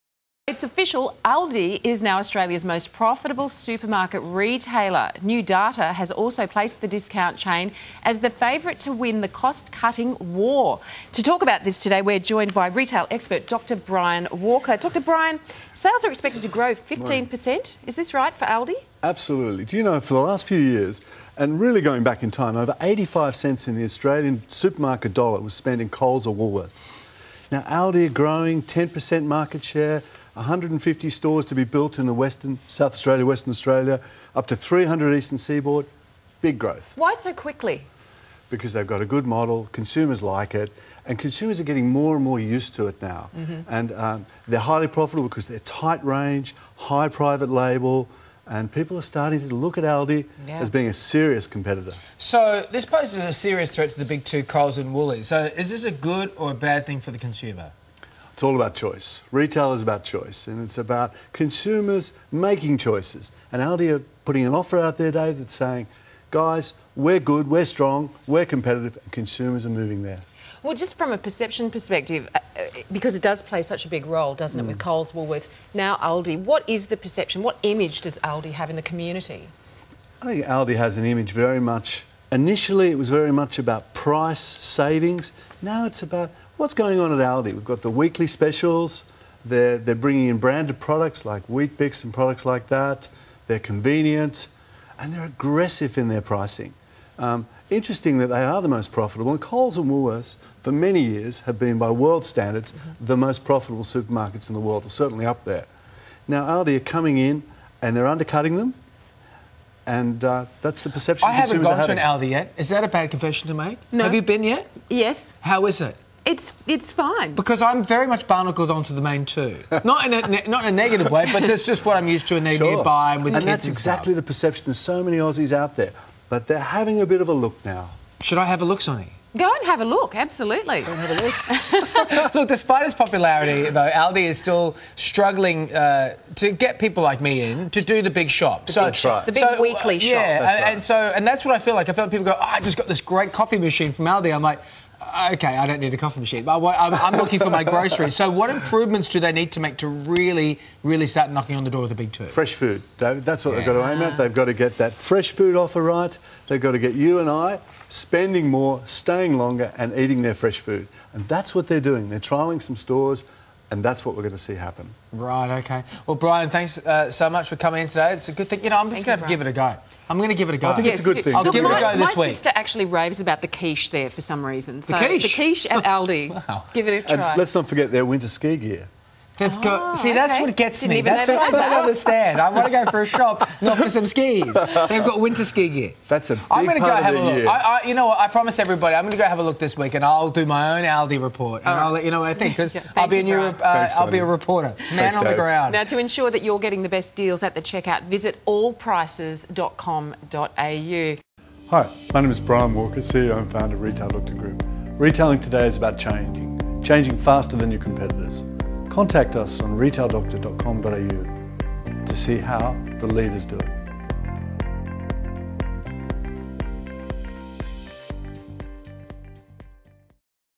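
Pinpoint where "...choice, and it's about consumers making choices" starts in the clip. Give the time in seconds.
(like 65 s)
60 s.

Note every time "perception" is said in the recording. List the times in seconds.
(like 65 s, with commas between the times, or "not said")
71 s, 76 s, 110 s, 124 s.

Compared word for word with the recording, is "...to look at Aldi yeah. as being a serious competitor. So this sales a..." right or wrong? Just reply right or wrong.
wrong.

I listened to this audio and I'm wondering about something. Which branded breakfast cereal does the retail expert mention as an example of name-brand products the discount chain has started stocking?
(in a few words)
Weet-Bix.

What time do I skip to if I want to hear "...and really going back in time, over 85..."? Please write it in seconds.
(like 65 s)
21 s.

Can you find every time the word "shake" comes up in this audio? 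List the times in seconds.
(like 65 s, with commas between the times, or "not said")
not said.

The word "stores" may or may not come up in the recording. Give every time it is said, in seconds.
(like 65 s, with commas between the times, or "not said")
31 s, 162 s.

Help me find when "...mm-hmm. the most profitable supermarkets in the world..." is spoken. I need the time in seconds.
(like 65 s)
102 s.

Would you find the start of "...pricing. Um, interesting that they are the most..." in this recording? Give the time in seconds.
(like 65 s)
96 s.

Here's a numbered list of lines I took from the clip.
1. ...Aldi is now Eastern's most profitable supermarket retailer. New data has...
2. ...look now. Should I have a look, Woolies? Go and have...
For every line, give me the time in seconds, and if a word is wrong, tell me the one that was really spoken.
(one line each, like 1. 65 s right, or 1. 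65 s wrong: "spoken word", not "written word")
1. 1 s wrong: "Australia", not "Eastern"
2. 127 s wrong: "Sonny", not "Woolies".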